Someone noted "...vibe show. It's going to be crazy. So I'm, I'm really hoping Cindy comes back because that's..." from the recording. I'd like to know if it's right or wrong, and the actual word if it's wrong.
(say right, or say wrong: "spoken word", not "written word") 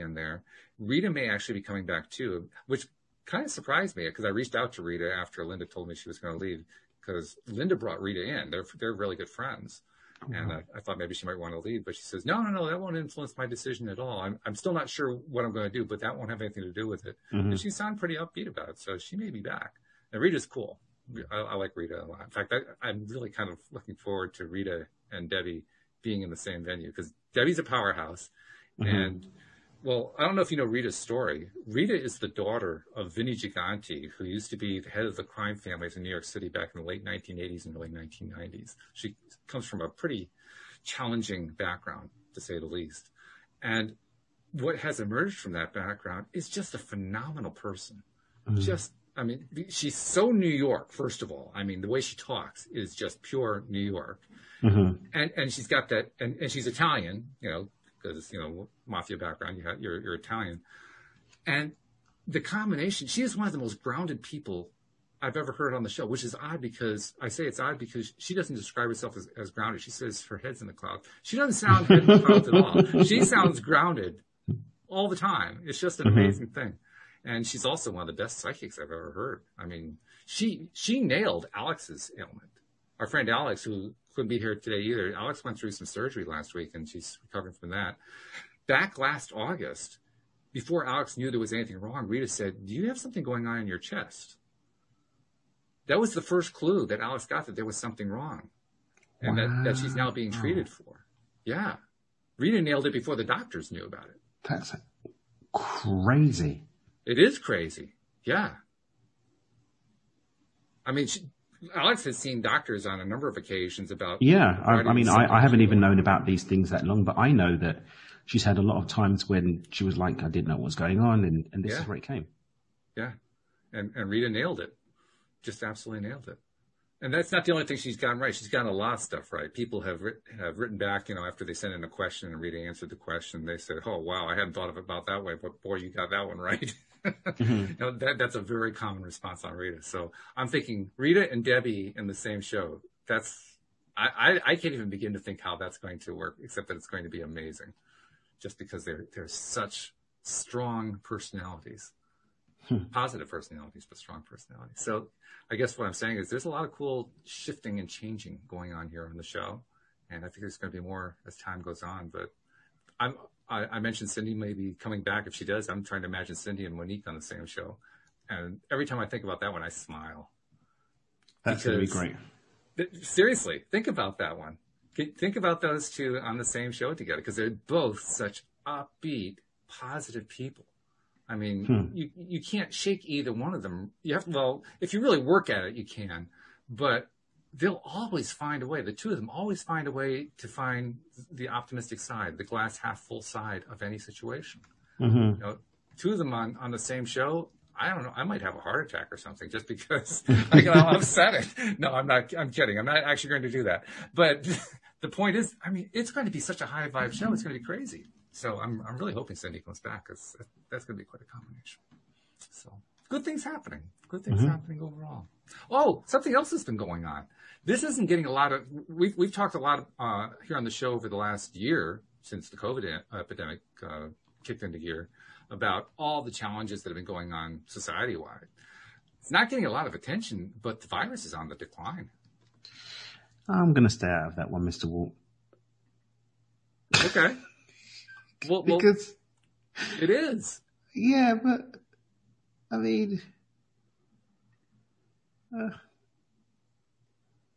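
right.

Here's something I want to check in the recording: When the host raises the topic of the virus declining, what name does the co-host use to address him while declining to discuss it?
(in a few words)
Mister Walt.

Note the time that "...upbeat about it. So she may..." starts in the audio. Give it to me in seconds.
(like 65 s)
18 s.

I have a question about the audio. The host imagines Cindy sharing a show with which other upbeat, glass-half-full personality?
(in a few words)
Monique.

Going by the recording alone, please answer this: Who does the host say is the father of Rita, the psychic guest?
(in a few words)
Vinnie Gigante.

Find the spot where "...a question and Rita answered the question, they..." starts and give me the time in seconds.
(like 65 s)
131 s.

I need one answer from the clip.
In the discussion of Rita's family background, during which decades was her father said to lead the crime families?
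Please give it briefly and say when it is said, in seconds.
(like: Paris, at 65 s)
late 1980s and early 1990s, at 36 s.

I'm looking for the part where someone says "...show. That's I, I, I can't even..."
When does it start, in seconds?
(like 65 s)
142 s.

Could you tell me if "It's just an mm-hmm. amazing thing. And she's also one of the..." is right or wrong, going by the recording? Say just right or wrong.
right.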